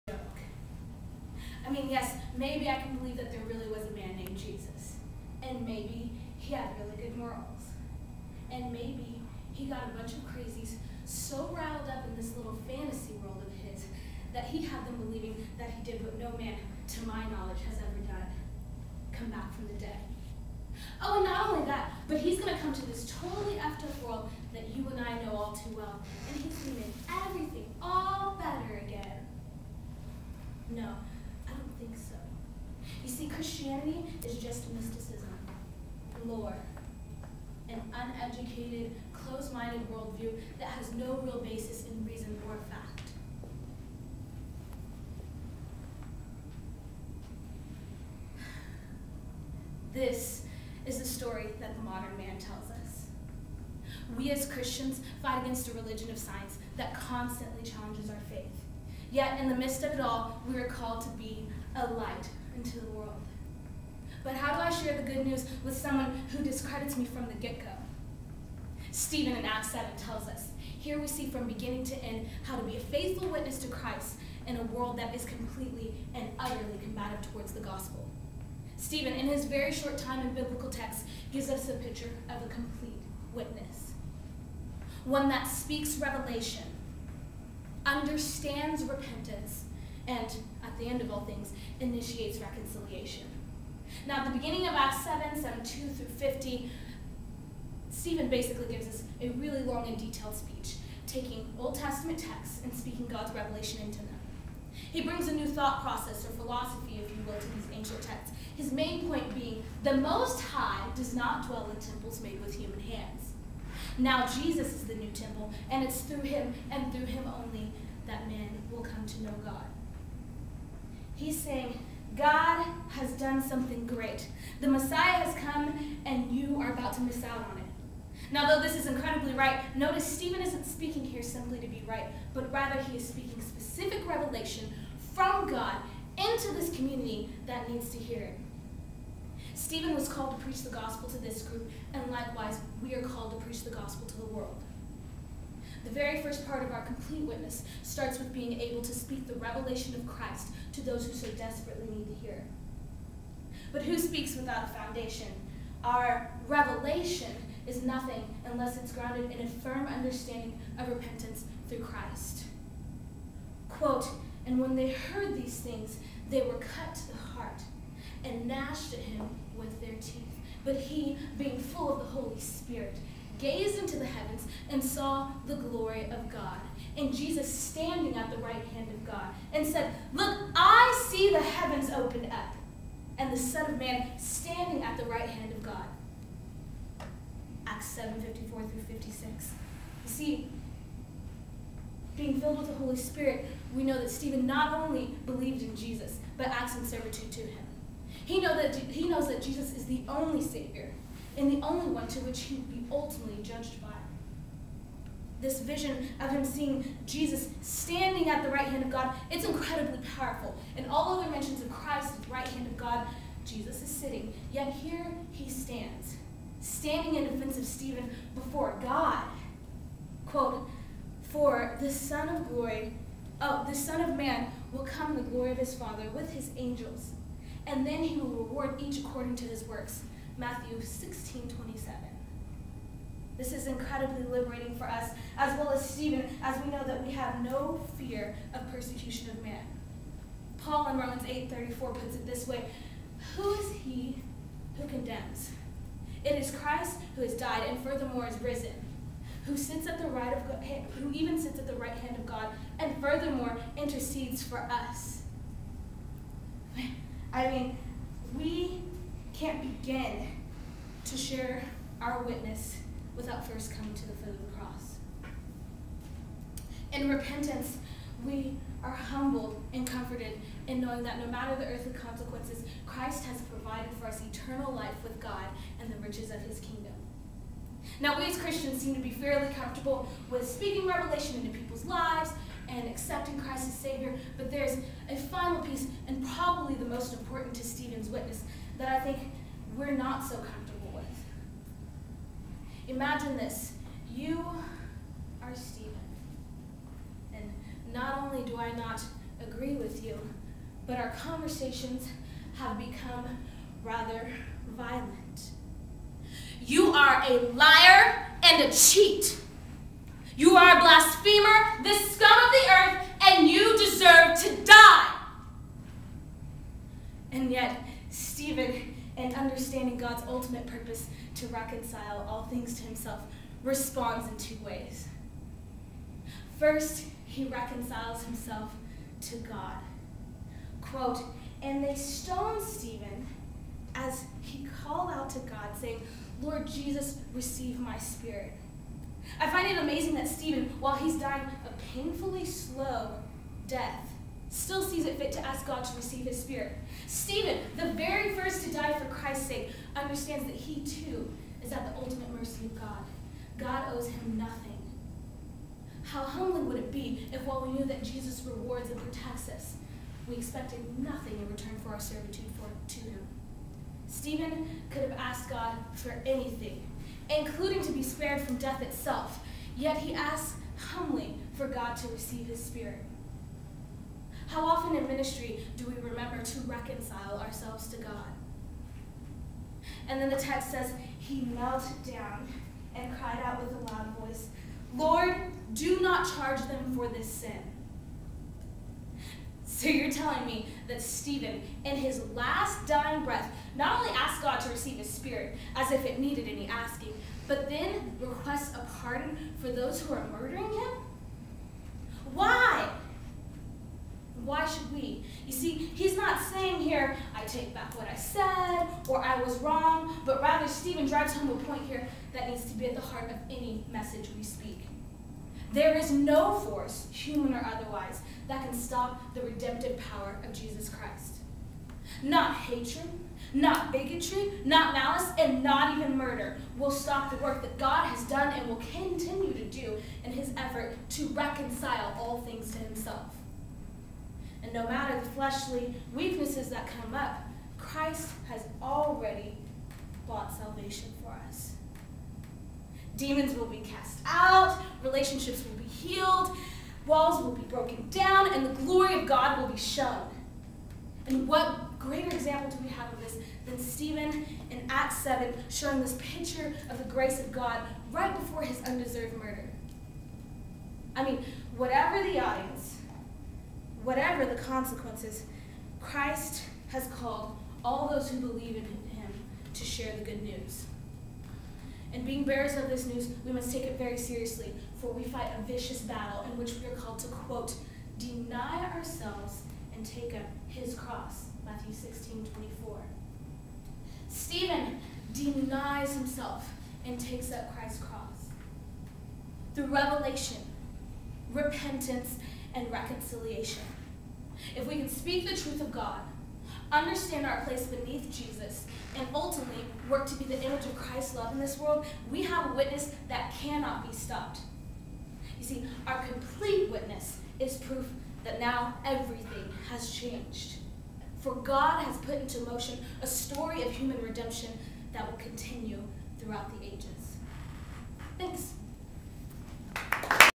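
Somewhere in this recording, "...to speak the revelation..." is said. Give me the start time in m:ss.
2:28.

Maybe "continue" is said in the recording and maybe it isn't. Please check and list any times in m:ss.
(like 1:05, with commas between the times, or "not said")
7:08, 8:35.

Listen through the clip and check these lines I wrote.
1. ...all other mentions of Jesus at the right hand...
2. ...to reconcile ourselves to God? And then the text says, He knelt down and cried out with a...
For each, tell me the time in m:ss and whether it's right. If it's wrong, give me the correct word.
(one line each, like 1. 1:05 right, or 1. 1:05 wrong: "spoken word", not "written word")
1. 3:30 wrong: "Christ", not "Jesus"
2. 6:16 right.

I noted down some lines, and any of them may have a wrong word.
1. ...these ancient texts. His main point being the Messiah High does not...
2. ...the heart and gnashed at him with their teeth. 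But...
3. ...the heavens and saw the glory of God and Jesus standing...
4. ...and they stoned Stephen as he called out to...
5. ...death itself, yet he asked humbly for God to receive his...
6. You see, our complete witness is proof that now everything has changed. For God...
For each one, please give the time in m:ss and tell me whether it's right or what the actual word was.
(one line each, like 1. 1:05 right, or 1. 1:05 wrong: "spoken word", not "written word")
1. 1:47 wrong: "Most", not "Messiah"
2. 2:47 right
3. 2:53 right
4. 5:31 right
5. 6:08 right
6. 8:25 right.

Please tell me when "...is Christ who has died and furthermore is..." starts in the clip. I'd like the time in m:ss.
4:06.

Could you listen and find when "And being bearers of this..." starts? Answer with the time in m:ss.
7:52.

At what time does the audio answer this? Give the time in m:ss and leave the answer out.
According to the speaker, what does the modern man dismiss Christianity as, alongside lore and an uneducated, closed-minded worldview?
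0:34.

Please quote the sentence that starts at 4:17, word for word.
I mean, we can't begin to share our witness without first coming to the foot of the cross.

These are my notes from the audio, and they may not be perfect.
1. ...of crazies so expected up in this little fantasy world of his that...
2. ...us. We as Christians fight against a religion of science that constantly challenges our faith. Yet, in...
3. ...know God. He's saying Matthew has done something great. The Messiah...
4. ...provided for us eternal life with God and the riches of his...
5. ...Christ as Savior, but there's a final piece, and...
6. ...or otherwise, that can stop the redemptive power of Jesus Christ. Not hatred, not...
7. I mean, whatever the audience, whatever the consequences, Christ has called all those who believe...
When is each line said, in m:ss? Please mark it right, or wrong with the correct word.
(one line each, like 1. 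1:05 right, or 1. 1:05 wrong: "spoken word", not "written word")
1. 0:10 wrong: "riled", not "expected"
2. 0:52 right
3. 1:59 wrong: "God", not "Matthew"
4. 4:33 right
5. 4:43 right
6. 6:57 right
7. 7:41 right.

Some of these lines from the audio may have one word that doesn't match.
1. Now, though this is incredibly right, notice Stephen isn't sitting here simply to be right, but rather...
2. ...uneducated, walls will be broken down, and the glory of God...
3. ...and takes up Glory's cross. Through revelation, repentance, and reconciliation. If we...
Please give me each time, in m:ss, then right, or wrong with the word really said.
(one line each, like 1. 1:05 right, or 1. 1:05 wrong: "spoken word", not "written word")
1. 2:08 wrong: "speaking", not "sitting"
2. 7:25 wrong: "healed", not "uneducated"
3. 8:07 wrong: "Christ", not "Glory".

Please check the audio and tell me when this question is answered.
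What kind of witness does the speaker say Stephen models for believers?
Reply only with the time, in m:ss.
1:22.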